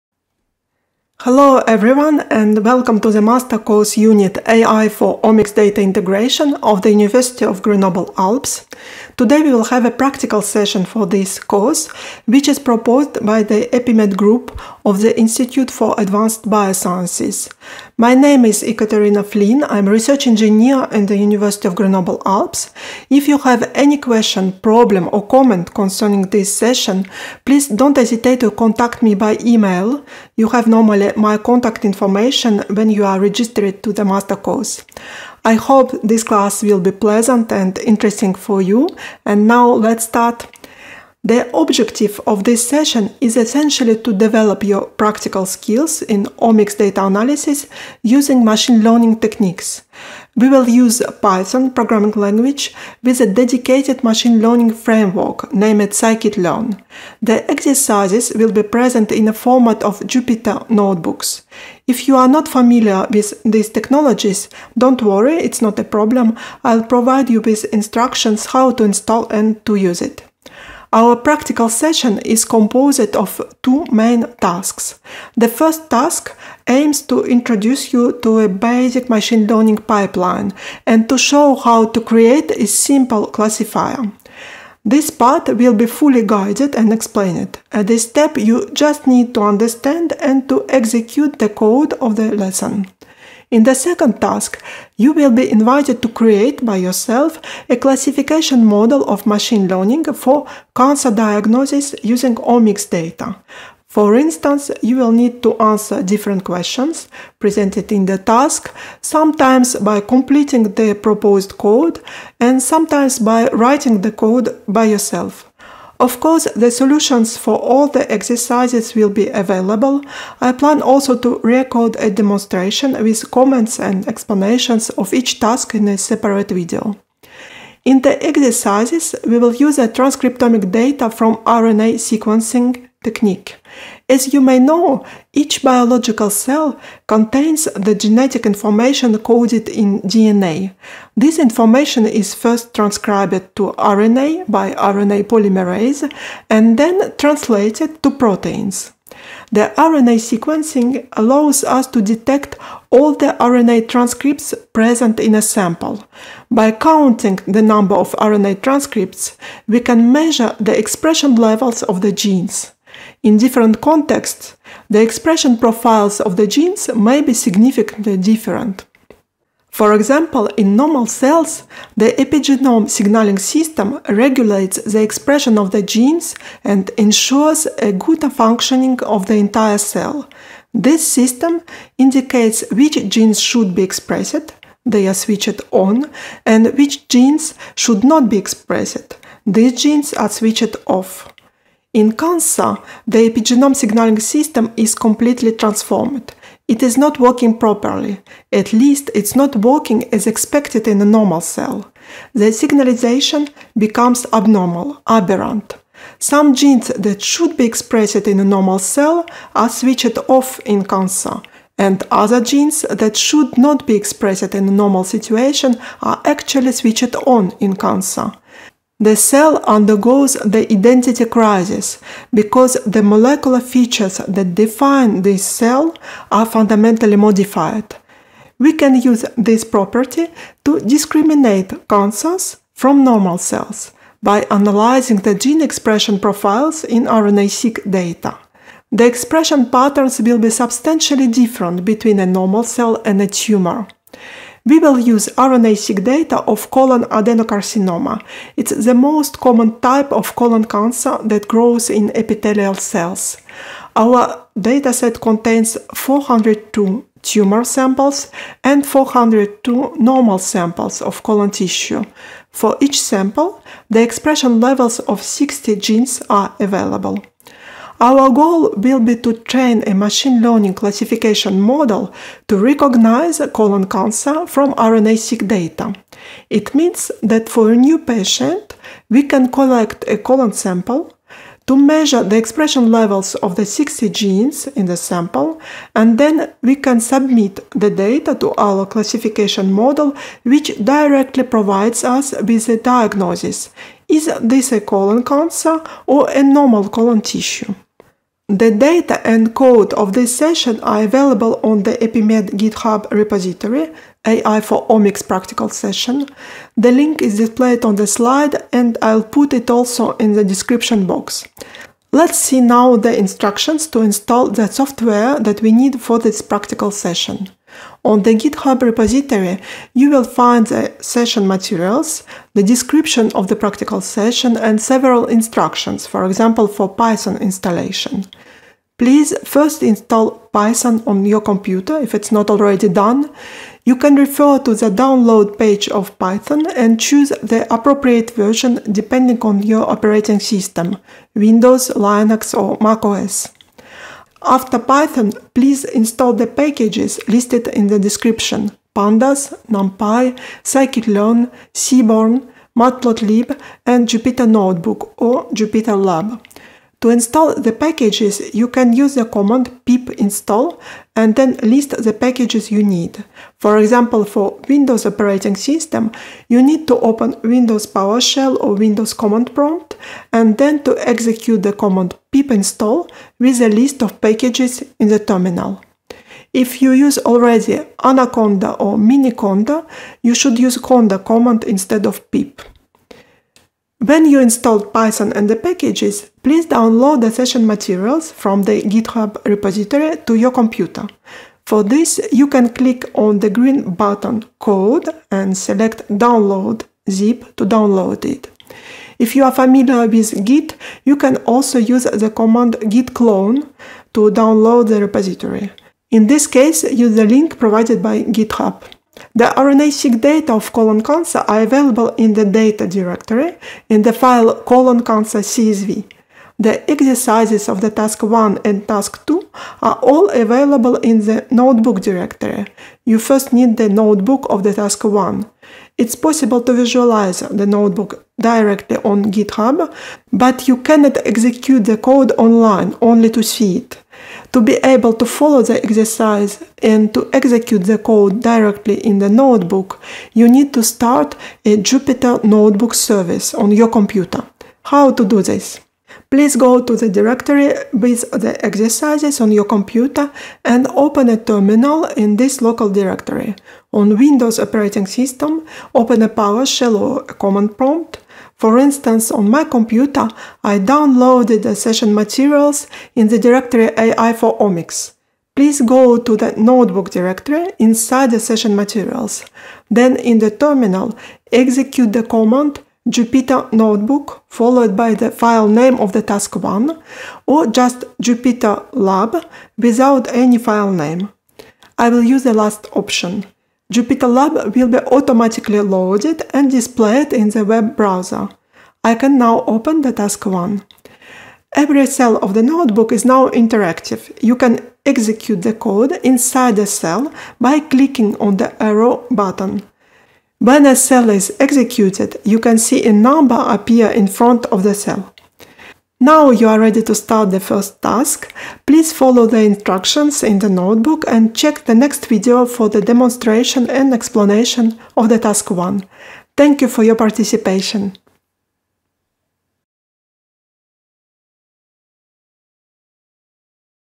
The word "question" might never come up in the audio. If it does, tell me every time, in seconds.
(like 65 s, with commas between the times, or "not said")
23 s, 106 s.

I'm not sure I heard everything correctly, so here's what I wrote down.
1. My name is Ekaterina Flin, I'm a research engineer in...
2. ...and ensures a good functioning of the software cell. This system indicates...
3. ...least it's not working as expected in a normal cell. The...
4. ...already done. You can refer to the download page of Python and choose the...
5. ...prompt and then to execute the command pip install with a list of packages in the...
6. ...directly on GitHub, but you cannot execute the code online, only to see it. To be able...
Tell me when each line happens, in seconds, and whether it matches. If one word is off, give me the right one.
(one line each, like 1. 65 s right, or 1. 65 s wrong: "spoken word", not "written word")
1. 17 s right
2. 176 s wrong: "entire", not "software"
3. 198 s right
4. 332 s right
5. 369 s right
6. 428 s right.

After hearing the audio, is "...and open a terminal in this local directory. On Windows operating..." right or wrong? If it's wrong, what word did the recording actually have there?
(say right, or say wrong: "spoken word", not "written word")
right.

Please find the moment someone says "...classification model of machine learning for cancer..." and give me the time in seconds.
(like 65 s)
97 s.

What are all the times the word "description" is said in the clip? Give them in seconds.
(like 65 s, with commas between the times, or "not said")
310 s, 322 s, 347 s.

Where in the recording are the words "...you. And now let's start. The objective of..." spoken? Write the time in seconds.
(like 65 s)
38 s.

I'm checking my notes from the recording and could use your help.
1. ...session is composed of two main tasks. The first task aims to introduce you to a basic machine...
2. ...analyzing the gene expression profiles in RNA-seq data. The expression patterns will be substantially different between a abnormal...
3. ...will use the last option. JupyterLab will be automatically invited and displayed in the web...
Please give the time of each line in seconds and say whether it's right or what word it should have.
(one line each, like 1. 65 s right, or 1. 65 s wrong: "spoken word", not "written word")
1. 71 s right
2. 234 s wrong: "normal", not "abnormal"
3. 482 s wrong: "loaded", not "invited".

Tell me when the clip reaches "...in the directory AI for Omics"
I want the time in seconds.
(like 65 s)
463 s.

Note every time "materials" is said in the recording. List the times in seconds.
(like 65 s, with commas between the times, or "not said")
321 s, 387 s, 462 s, 468 s.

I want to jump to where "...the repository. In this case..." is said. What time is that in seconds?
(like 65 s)
404 s.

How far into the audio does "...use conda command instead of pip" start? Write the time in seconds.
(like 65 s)
380 s.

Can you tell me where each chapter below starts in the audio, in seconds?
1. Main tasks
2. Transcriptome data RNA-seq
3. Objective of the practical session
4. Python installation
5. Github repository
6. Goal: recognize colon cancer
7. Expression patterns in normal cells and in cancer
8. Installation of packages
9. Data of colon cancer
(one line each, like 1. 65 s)
1. 70 s
2. 127 s
3. 40 s
4. 328 s
5. 297 s
6. 266 s
7. 169 s
8. 343 s
9. 243 s.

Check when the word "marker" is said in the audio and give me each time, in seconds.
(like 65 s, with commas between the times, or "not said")
not said.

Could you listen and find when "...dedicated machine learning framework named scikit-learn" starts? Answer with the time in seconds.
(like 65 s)
53 s.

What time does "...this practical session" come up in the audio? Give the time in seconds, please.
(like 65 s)
316 s.